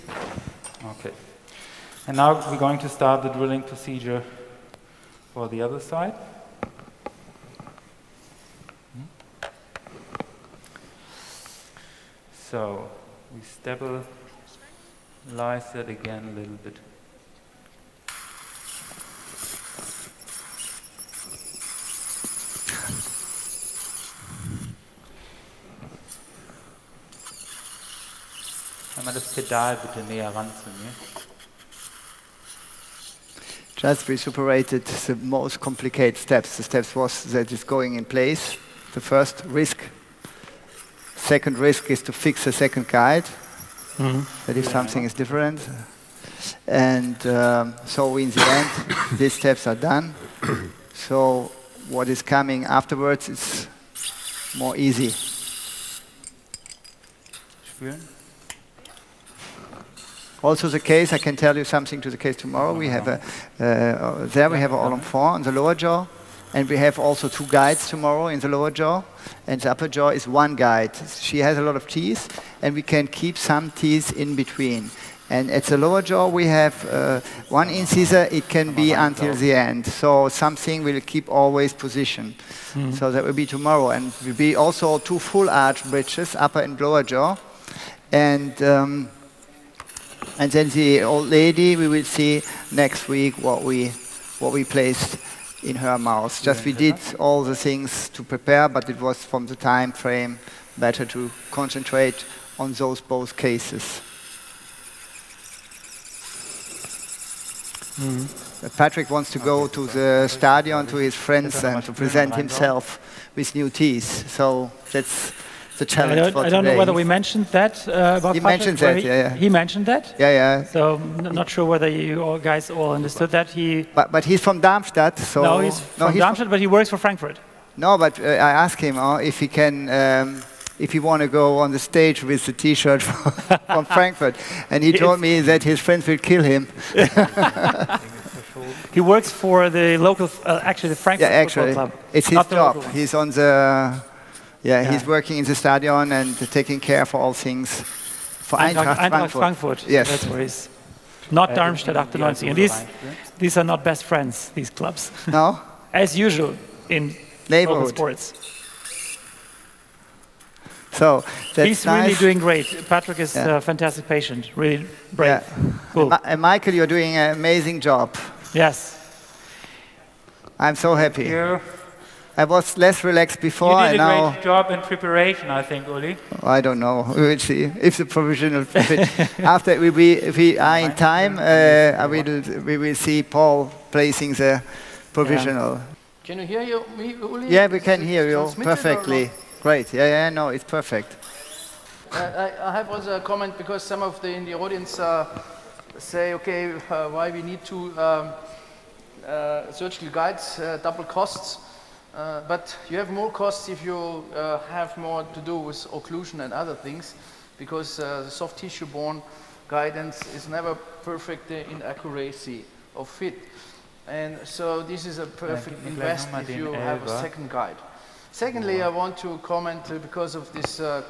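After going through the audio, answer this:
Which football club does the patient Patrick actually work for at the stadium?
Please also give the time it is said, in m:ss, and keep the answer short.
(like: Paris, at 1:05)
Eintracht Frankfurt, at 2:28.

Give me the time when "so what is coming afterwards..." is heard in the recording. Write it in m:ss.
0:51.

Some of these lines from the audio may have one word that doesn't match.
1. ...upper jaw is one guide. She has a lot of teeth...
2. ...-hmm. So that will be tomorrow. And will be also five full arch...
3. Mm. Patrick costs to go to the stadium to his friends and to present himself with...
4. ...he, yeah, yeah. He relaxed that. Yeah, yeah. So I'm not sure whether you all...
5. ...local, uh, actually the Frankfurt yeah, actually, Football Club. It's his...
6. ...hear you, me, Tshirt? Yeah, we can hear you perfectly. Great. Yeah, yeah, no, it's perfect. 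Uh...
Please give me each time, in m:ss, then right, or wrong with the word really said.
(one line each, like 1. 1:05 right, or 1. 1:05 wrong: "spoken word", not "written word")
1. 1:09 right
2. 1:22 wrong: "two", not "five"
3. 1:47 wrong: "wants", not "costs"
4. 1:58 wrong: "mentioned", not "relaxed"
5. 2:19 right
6. 3:06 wrong: "Uli", not "Tshirt".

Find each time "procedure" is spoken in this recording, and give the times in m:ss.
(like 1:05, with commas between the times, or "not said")
0:03.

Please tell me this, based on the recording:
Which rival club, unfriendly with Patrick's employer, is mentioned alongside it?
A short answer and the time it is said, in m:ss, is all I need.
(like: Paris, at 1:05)
Darmstadt 98, at 2:31.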